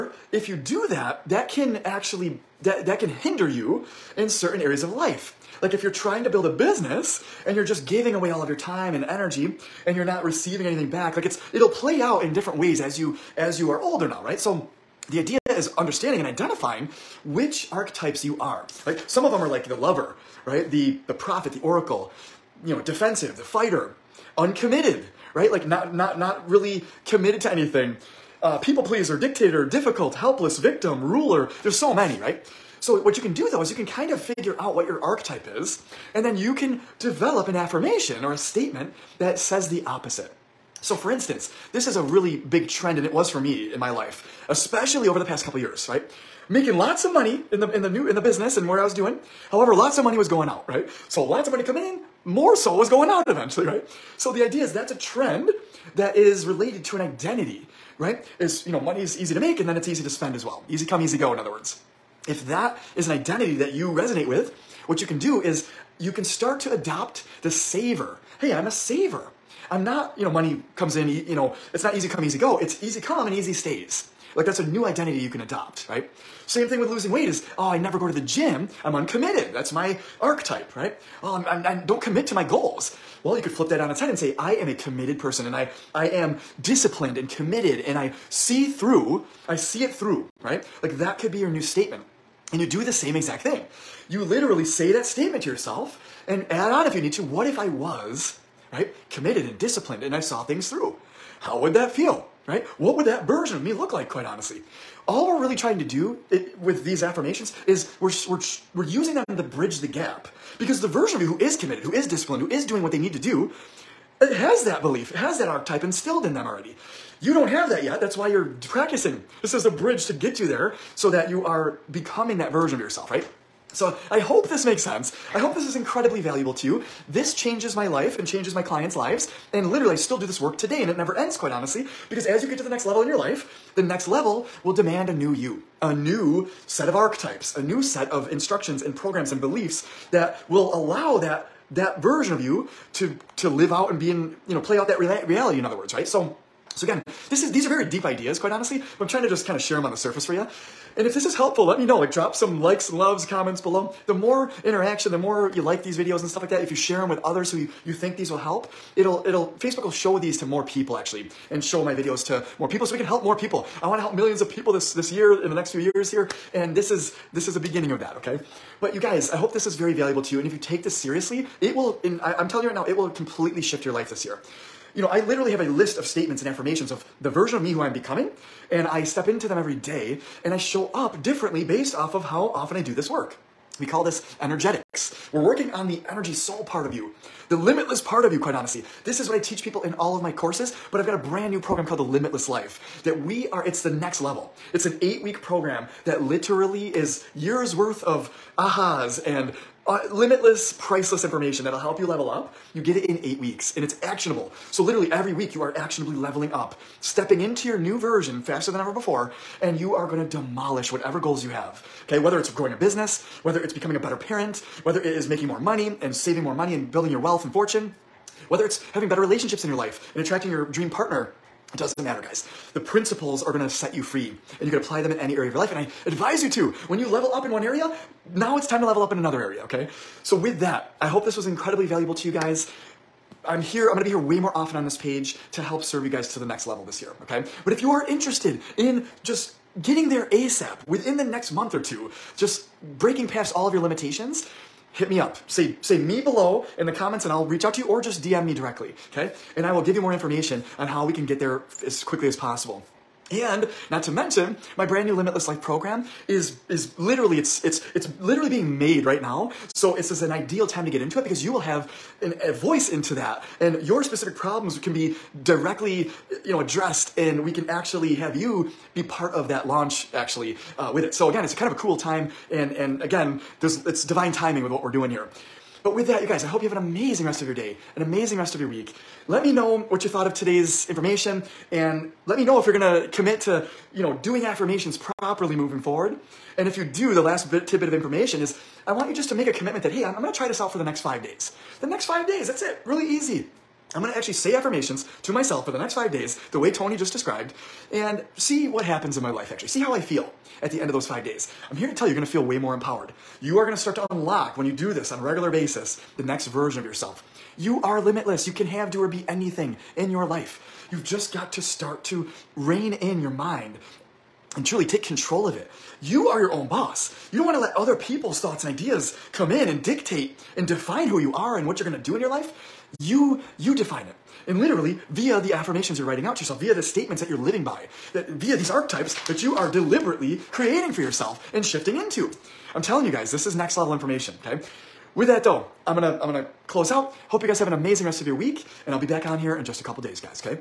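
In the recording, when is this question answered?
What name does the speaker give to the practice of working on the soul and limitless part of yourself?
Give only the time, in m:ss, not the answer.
3:04.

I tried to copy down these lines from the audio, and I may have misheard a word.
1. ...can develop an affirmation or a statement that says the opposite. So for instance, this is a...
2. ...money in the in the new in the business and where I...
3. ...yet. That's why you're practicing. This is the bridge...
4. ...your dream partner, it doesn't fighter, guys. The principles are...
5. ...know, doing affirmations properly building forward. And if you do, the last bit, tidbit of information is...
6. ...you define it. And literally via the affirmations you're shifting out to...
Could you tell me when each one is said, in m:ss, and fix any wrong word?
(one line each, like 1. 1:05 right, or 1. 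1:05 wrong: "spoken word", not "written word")
1. 0:36 right
2. 0:47 right
3. 1:57 right
4. 3:40 wrong: "matter", not "fighter"
5. 4:44 wrong: "moving", not "building"
6. 5:23 wrong: "writing", not "shifting".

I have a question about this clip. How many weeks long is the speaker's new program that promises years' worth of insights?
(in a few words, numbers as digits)
8.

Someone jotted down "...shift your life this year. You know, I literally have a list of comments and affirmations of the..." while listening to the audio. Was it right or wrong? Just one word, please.
wrong.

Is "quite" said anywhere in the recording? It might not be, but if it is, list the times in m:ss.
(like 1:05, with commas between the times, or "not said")
1:44, 2:11, 2:28, 3:08.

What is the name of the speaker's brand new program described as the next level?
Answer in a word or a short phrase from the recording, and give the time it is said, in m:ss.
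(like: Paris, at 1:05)
The Limitless Life, at 3:11.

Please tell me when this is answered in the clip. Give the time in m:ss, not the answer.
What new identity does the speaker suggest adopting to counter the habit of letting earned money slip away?
1:07.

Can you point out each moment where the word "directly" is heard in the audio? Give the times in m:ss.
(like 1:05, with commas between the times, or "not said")
4:08, 4:25.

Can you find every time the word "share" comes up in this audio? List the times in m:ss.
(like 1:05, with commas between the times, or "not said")
2:29, 2:36.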